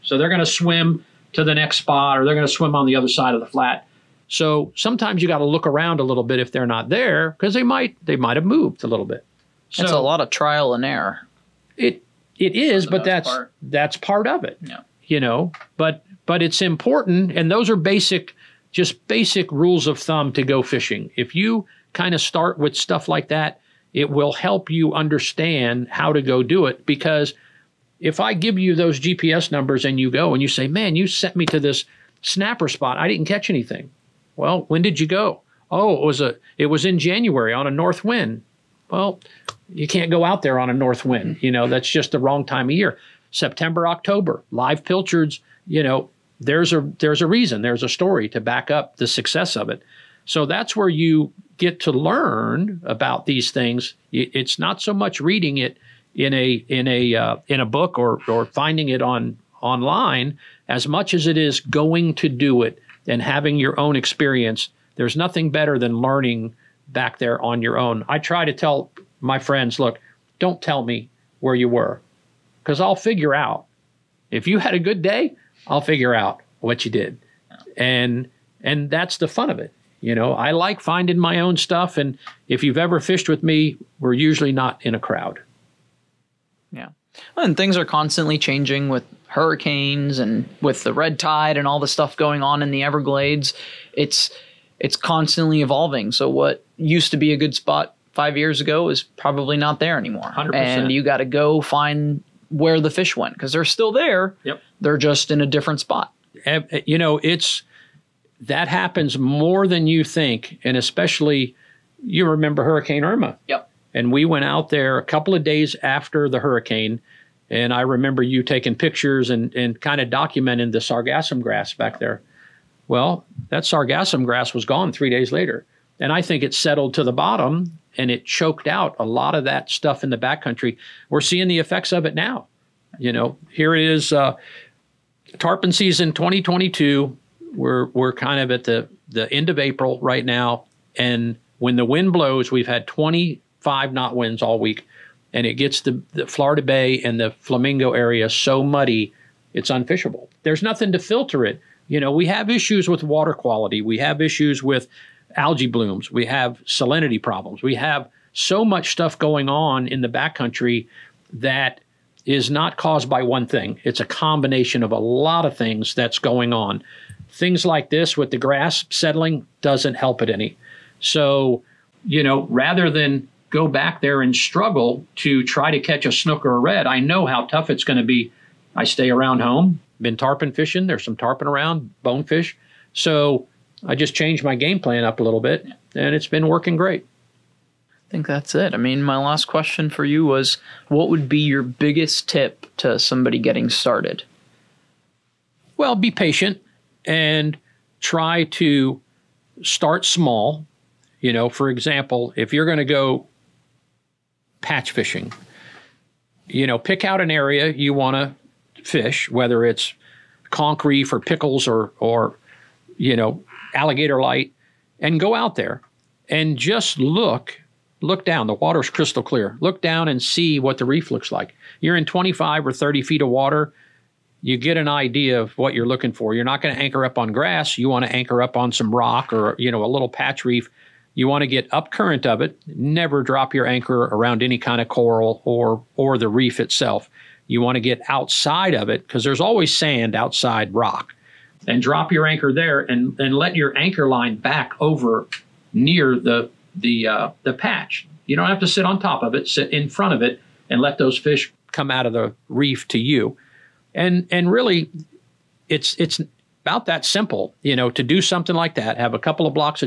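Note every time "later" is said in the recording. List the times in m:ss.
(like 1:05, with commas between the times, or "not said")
2:05.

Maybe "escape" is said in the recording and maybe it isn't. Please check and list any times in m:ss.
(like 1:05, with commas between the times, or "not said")
not said.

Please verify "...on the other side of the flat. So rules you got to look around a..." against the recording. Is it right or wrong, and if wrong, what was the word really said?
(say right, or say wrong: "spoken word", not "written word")
wrong: "sometimes", not "rules".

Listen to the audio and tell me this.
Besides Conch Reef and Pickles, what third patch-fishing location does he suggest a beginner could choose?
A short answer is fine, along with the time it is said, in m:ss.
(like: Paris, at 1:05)
Alligator Light, at 3:33.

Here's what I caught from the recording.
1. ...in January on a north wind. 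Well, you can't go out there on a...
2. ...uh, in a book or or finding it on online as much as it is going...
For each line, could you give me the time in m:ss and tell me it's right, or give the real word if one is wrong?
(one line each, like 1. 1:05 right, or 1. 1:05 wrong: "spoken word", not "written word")
1. 0:36 right
2. 0:57 right.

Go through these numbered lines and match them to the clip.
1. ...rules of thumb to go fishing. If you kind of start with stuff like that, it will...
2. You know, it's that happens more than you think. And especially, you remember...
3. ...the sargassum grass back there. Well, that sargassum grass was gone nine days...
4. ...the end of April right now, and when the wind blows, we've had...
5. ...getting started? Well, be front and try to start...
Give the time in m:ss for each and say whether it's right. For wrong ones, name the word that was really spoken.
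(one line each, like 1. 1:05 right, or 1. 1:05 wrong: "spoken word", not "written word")
1. 0:19 right
2. 1:46 right
3. 2:00 wrong: "three", not "nine"
4. 2:19 right
5. 3:13 wrong: "patient", not "front".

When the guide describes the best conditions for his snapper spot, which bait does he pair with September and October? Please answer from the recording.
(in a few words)
live pilchards.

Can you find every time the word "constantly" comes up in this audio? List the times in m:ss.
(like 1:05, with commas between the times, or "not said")
1:27, 1:34.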